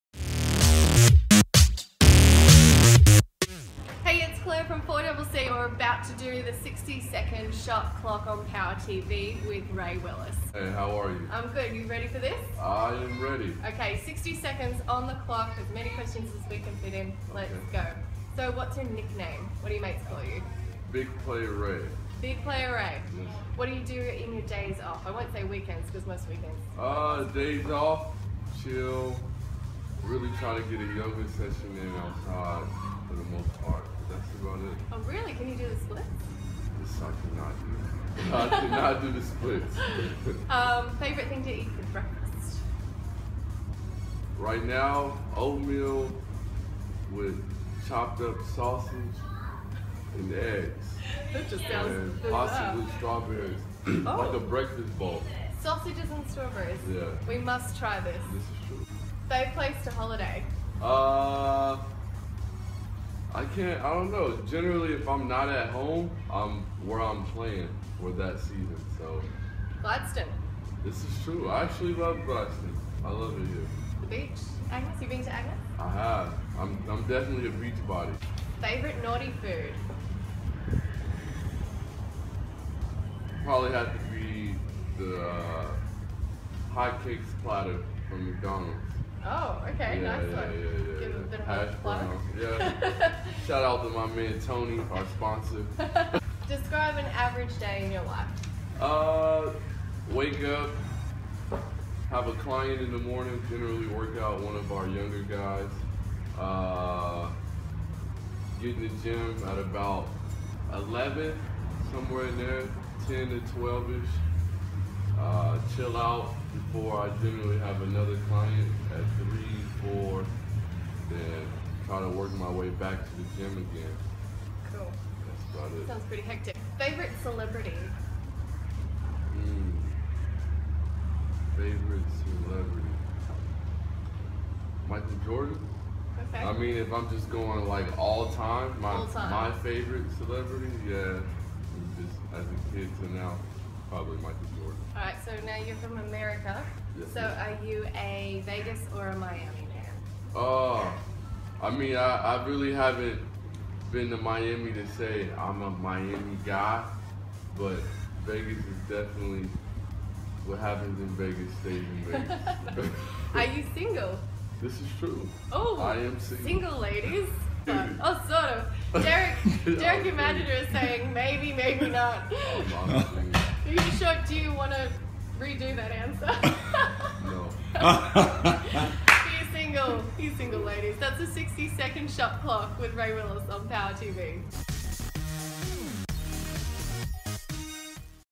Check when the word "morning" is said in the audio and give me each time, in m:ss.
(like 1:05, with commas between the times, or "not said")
1:42.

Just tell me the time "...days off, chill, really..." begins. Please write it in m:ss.
0:27.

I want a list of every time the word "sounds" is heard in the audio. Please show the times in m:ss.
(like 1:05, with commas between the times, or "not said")
0:51, 2:05.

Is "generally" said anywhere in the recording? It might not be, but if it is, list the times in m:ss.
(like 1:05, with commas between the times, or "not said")
1:04, 1:43, 1:57.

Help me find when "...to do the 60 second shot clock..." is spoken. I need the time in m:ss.
0:06.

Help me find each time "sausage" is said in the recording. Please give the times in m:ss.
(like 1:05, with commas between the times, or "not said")
0:48, 0:55.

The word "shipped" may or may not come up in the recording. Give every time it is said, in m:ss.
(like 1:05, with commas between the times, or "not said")
not said.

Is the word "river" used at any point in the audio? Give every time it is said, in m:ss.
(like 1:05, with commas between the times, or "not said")
not said.